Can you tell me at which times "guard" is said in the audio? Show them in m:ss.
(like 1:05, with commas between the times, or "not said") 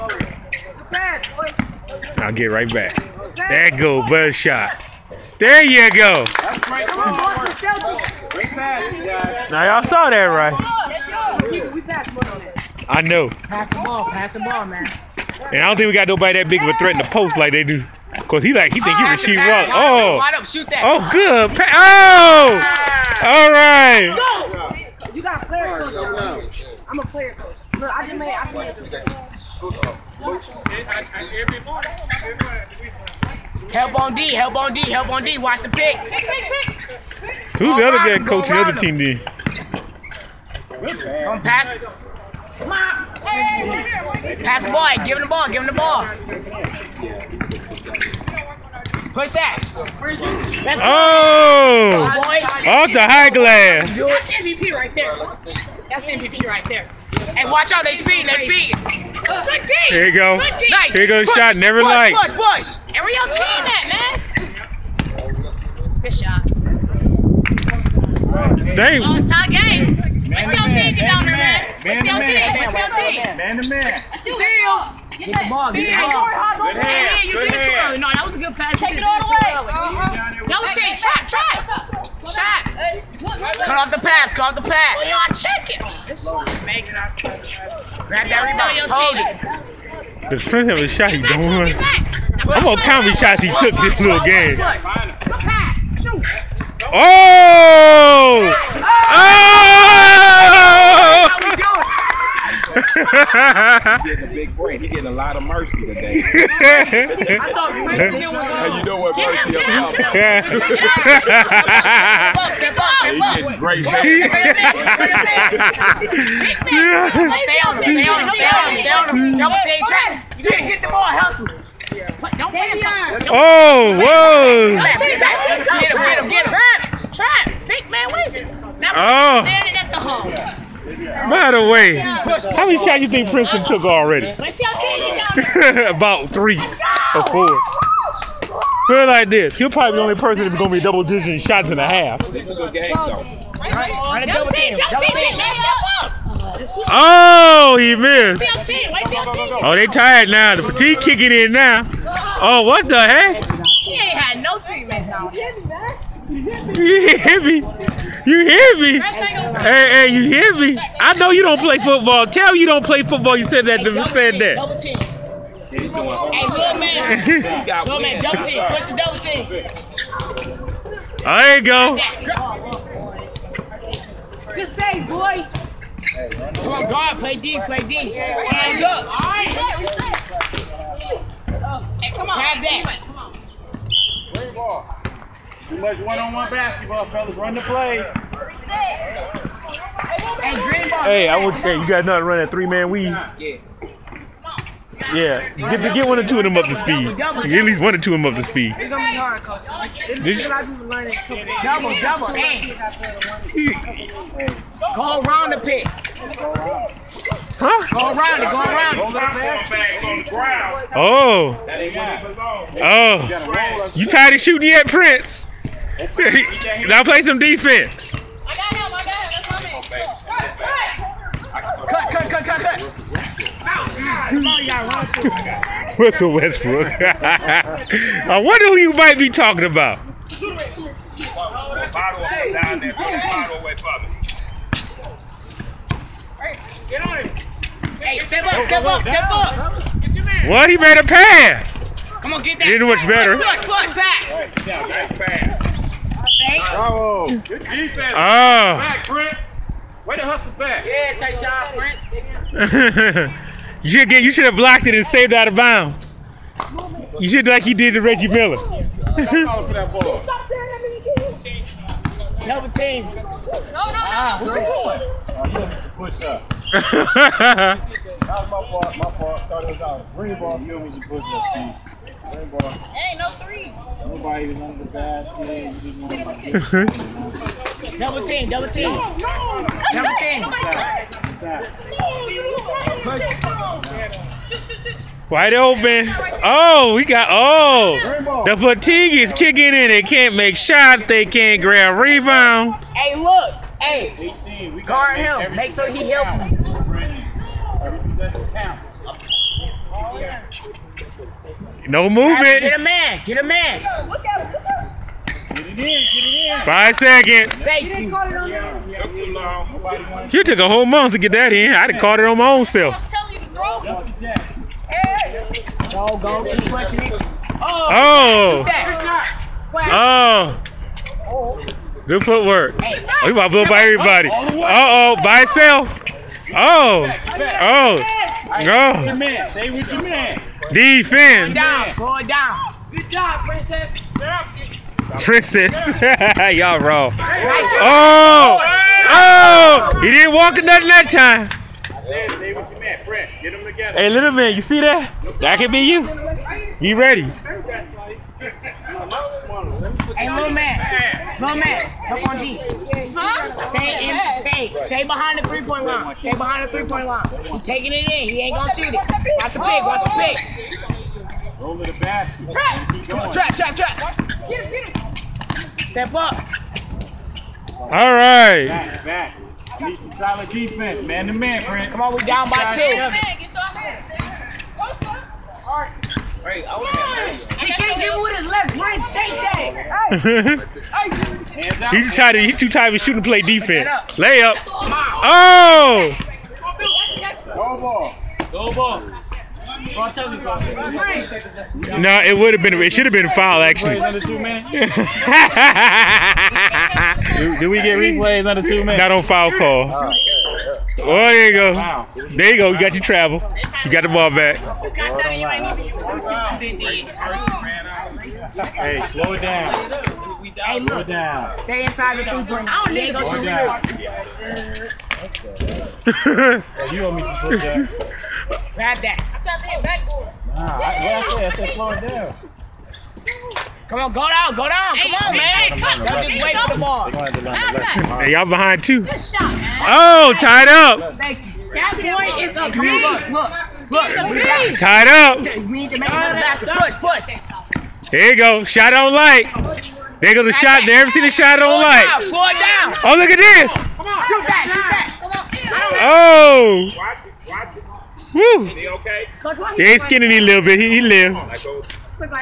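2:56, 4:54.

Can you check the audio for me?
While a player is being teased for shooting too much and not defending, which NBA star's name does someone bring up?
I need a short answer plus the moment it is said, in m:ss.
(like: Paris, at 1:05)
Westbrook, at 3:46.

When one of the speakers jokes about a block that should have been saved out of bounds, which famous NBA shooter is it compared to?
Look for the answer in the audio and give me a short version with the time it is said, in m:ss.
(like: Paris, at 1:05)
Reggie Miller, at 4:18.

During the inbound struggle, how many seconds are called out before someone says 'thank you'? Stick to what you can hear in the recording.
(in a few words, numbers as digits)
5.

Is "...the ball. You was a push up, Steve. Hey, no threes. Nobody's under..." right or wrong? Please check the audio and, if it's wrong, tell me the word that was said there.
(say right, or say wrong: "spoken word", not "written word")
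right.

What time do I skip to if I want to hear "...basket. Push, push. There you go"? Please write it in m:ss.
7:16.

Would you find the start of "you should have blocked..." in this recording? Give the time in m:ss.
4:14.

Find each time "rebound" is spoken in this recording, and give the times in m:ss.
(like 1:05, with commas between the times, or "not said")
1:28, 4:51.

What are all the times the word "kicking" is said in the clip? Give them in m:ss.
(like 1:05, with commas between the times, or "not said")
2:30, 4:49.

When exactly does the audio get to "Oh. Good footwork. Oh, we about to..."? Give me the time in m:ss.
5:21.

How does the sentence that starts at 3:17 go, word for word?
Get at least one or two of them up to speed.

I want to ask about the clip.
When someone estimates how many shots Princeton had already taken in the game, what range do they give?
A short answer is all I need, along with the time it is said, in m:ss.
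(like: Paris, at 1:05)
three or four, at 2:16.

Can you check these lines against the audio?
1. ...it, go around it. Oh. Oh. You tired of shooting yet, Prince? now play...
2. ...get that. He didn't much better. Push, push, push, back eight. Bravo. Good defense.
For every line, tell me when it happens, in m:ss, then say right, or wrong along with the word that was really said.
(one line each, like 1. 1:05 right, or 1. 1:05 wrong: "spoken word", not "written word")
1. 3:28 right
2. 4:02 right.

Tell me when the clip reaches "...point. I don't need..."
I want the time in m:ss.
6:52.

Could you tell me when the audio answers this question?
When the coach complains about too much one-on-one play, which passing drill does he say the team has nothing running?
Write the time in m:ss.
3:12.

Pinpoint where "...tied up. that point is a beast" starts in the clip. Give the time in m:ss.
7:10.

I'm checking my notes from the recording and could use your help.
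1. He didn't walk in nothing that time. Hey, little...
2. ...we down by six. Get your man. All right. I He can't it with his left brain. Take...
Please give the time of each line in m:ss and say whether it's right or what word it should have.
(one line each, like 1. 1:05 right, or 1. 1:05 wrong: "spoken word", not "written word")
1. 5:40 right
2. 6:12 wrong: "two", not "six".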